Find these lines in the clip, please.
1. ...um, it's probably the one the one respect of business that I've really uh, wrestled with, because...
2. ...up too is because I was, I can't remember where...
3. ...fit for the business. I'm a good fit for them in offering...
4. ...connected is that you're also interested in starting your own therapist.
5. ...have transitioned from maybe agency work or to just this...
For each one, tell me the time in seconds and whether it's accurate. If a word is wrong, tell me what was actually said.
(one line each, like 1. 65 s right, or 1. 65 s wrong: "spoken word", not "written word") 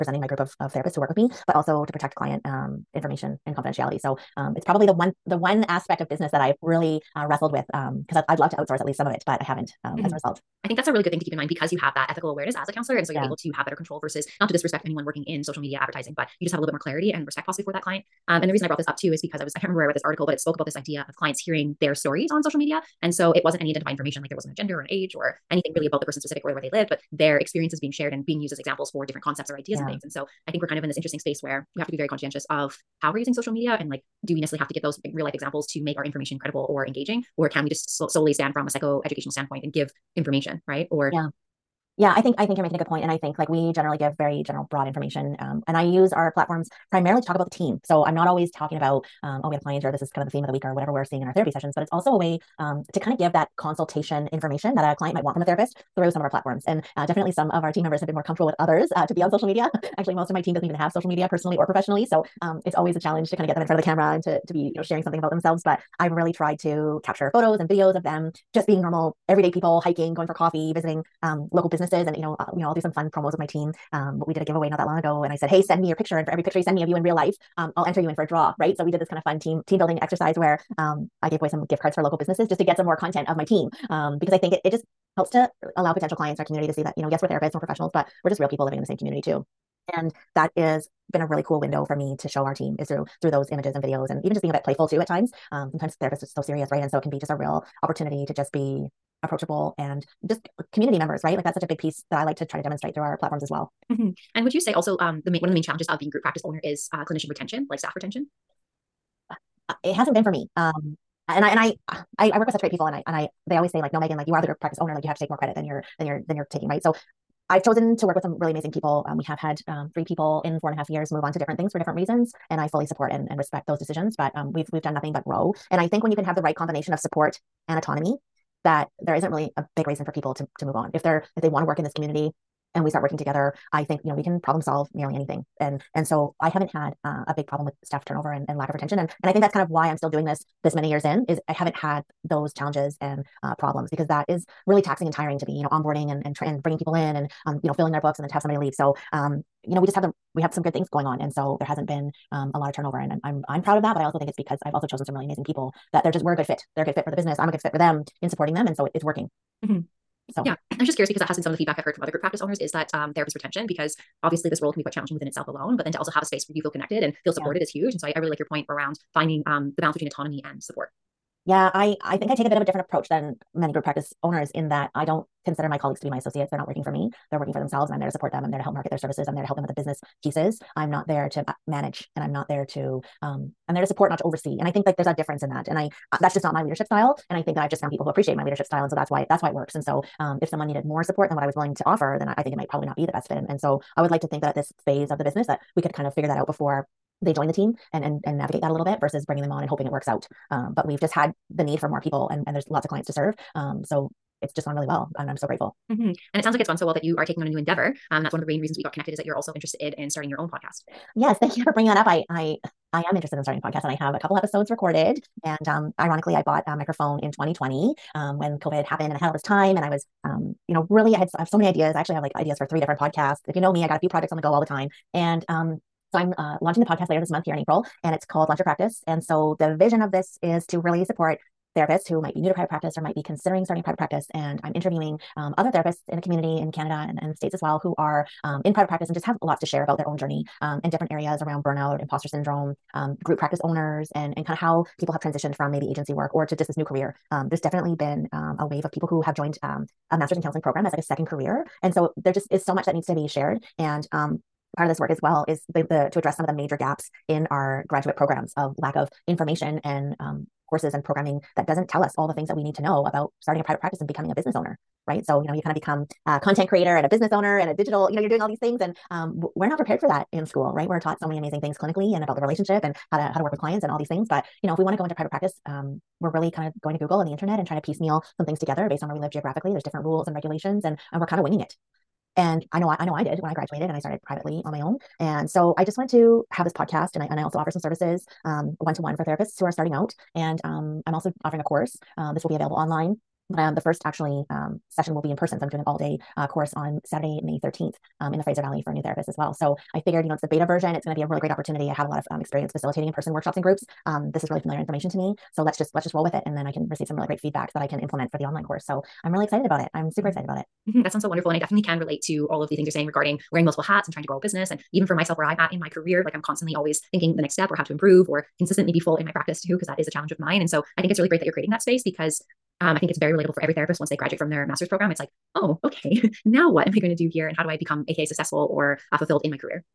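1. 4 s wrong: "aspect", not "respect"
2. 18 s right
3. 156 s wrong: "supporting", not "offering"
4. 208 s wrong: "podcast", not "therapist"
5. 245 s right.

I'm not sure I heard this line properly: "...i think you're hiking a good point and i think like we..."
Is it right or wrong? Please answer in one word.
wrong.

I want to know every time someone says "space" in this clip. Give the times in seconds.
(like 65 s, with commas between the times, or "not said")
31 s, 166 s, 321 s.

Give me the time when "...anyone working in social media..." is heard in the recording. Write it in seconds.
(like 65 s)
14 s.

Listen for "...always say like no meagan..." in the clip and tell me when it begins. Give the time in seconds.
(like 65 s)
113 s.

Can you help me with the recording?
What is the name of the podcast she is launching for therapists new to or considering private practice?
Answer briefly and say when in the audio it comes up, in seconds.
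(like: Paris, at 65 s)
Launch Your Practice, at 228 s.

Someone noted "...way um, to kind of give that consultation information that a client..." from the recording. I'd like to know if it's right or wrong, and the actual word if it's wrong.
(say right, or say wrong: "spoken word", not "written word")
right.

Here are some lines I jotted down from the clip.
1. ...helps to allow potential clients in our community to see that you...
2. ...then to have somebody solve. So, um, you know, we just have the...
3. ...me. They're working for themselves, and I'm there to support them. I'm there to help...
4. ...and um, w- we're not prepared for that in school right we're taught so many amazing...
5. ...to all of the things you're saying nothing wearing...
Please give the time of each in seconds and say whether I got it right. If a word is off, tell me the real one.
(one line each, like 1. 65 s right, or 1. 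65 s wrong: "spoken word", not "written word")
1. 85 s right
2. 148 s wrong: "leave", not "solve"
3. 176 s right
4. 268 s right
5. 312 s wrong: "regarding", not "nothing".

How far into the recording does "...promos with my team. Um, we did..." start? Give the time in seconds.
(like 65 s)
73 s.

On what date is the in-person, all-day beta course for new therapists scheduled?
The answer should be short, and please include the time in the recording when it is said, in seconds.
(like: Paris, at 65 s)
Saturday, May 13, at 297 s.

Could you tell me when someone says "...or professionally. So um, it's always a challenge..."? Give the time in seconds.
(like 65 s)
61 s.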